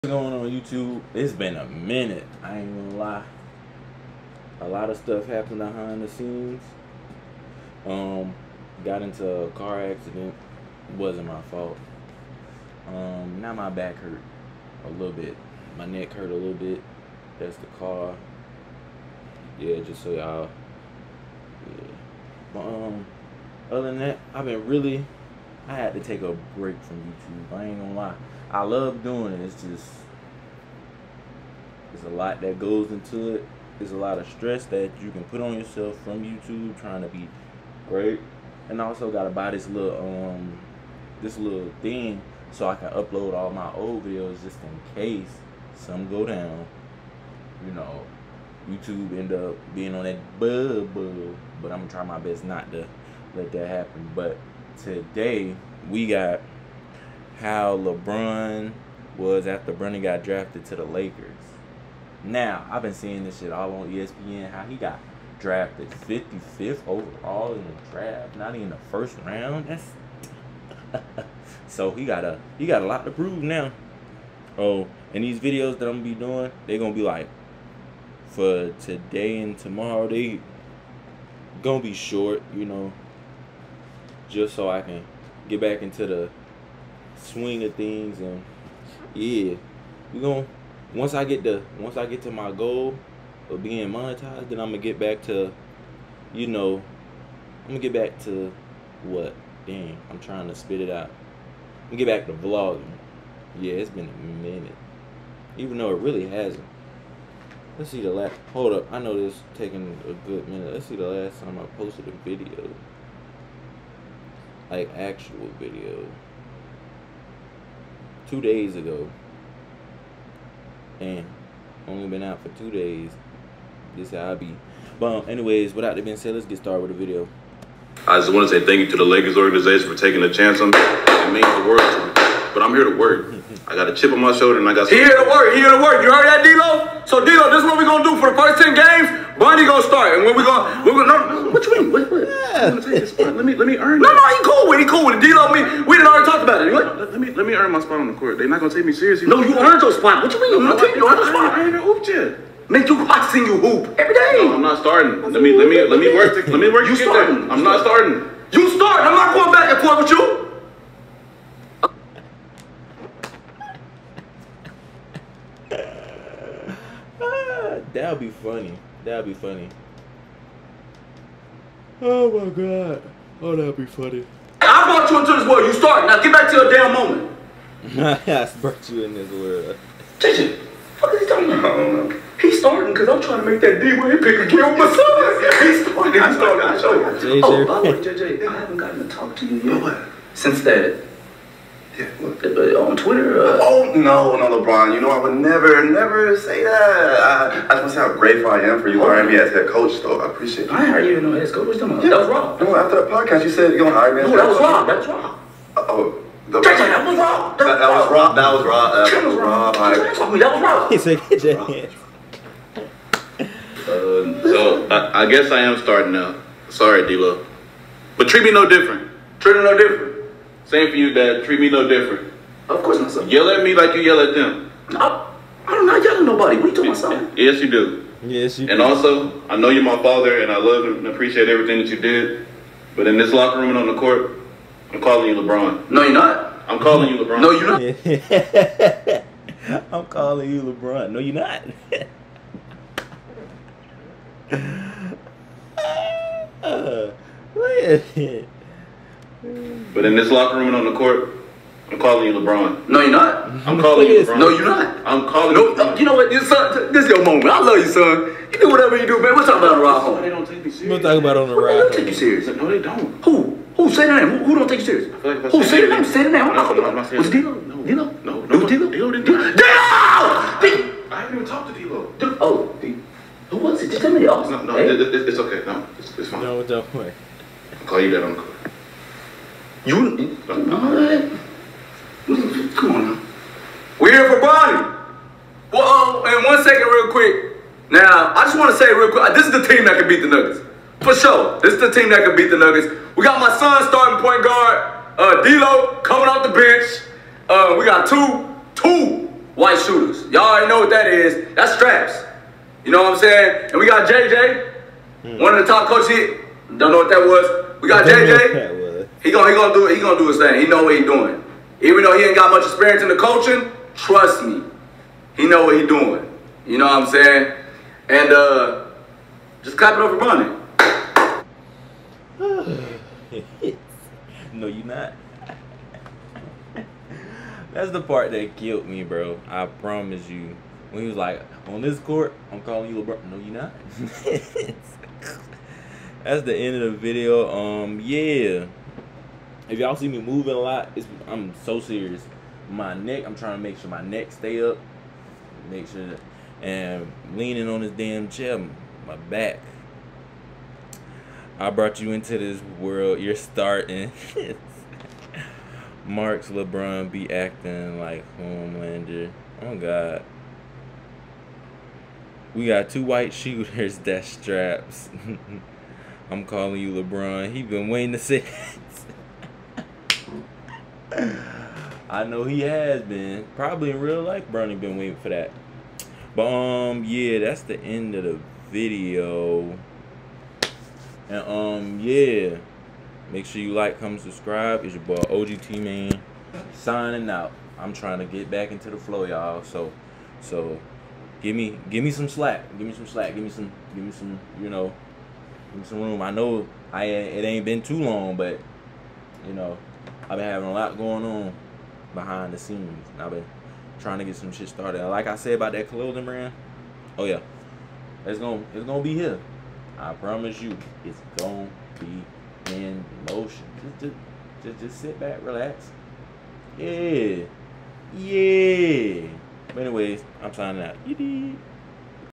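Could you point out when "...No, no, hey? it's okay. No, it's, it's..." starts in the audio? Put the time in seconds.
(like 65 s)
274 s.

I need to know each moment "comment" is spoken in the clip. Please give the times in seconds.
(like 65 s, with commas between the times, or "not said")
383 s.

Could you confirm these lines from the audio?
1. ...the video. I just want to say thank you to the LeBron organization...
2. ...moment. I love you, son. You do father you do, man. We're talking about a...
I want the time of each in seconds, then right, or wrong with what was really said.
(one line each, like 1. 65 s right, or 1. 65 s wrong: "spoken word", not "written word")
1. 126 s wrong: "Lakers", not "LeBron"
2. 257 s wrong: "whatever", not "father".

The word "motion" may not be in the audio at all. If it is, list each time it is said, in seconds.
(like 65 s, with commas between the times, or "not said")
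413 s.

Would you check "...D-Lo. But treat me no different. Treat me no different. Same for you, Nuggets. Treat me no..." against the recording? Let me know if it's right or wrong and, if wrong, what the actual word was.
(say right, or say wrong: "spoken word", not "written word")
wrong: "Dad", not "Nuggets".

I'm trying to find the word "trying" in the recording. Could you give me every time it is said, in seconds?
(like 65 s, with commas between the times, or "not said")
36 s, 100 s, 183 s, 343 s, 387 s, 403 s.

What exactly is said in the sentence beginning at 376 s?
But um, yeah, that's the end of the video.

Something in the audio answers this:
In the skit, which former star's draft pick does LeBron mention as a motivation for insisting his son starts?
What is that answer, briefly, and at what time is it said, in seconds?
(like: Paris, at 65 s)
D Wade, at 183 s.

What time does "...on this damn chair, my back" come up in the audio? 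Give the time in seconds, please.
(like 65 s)
347 s.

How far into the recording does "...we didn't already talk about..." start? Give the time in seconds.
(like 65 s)
145 s.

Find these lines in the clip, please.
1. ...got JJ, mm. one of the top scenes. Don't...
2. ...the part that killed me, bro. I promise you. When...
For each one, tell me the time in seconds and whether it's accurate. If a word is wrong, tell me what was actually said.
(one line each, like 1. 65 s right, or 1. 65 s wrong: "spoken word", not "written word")
1. 303 s wrong: "coaches", not "scenes"
2. 327 s right.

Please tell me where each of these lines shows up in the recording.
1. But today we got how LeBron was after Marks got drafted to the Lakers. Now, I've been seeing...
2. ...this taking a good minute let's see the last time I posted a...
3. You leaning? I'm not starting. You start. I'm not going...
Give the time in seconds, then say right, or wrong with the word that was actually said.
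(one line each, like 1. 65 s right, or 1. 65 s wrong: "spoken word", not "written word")
1. 54 s wrong: "Bronny", not "Marks"
2. 109 s right
3. 156 s wrong: "starting", not "leaning".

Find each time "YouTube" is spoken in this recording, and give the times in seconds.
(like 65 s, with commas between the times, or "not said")
0 s, 27 s, 36 s, 48 s.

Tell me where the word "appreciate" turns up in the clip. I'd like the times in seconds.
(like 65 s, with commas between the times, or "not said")
200 s, 231 s.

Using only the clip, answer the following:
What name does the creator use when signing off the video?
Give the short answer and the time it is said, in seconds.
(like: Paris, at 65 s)
OGT Mane, at 385 s.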